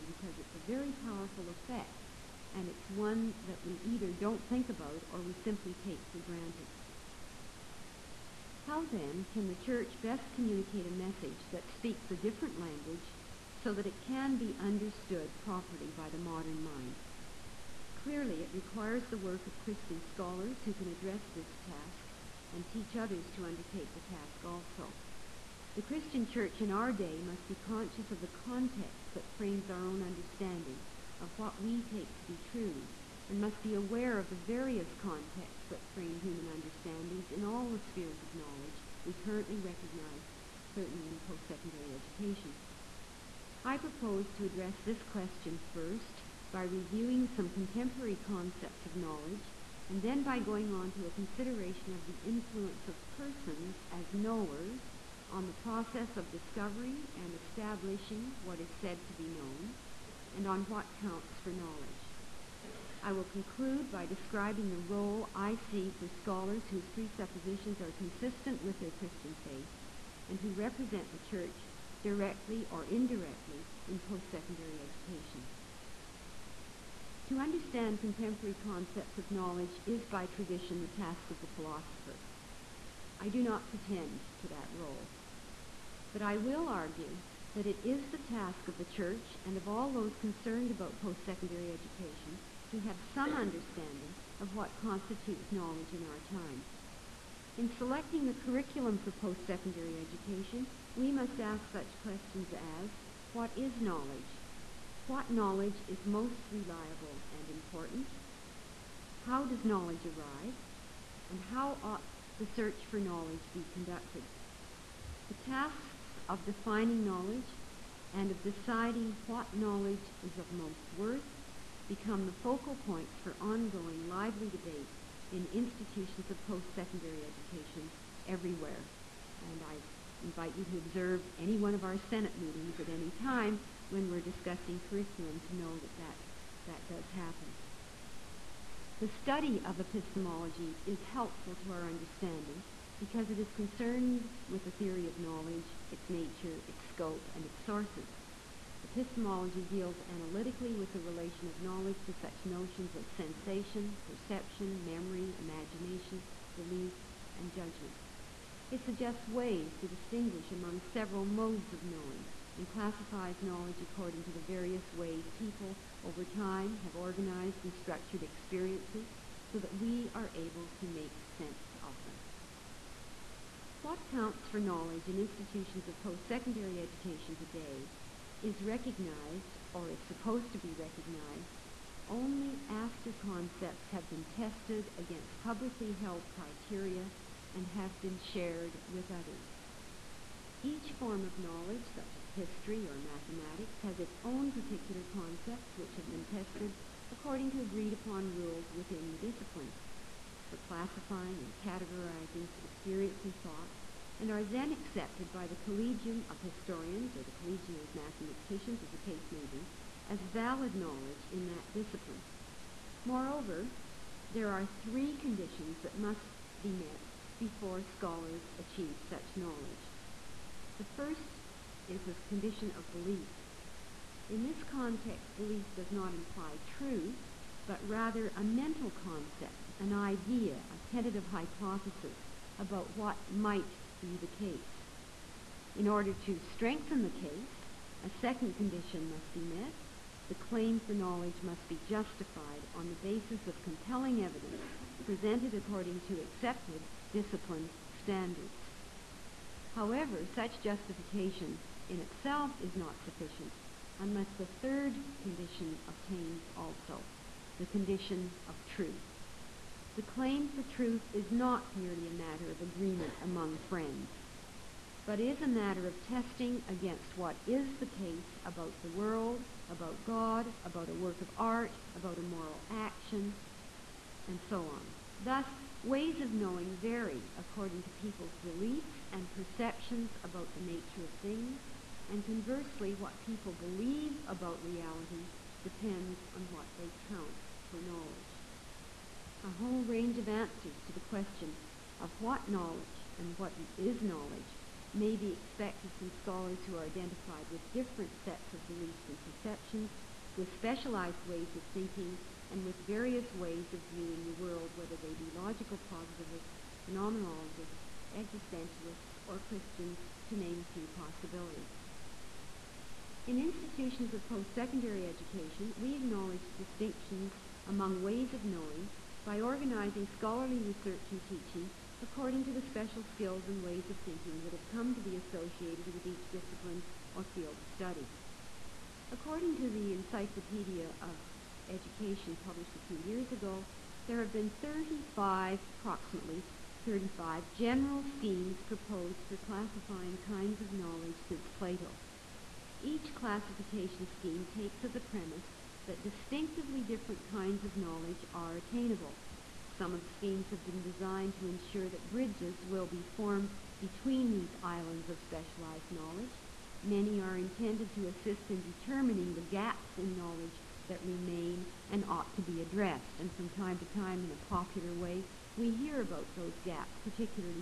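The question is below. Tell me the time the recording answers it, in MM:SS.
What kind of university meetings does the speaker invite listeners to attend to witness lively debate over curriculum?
02:12.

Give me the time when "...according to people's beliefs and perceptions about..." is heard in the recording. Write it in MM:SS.
04:37.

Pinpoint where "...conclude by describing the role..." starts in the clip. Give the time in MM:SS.
01:03.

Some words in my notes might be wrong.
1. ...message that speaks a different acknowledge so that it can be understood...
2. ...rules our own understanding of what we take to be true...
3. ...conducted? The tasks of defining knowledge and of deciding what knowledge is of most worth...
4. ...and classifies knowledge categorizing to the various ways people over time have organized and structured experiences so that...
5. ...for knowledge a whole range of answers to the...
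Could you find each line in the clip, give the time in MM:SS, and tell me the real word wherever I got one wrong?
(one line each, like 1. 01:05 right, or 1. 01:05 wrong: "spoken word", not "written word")
1. 00:10 wrong: "language", not "acknowledge"
2. 00:29 wrong: "frames", not "rules"
3. 01:53 right
4. 02:42 wrong: "according", not "categorizing"
5. 04:47 right.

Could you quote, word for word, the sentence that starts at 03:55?
In order to strengthen the case, a second condition must be met.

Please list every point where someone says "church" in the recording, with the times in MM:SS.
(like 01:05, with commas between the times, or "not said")
00:09, 00:26, 01:11, 01:28.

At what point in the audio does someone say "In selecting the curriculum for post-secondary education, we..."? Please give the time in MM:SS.
01:37.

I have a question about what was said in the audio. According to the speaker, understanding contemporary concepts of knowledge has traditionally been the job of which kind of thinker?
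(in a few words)
The philosopher.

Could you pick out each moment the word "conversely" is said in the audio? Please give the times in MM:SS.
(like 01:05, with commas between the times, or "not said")
04:42.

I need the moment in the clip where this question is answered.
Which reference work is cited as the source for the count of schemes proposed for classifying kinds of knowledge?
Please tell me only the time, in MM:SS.
05:29.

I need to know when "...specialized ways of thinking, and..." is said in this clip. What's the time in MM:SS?
05:00.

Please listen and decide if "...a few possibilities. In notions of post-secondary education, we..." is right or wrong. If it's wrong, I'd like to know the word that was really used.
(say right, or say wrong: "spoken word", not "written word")
wrong: "institutions", not "notions".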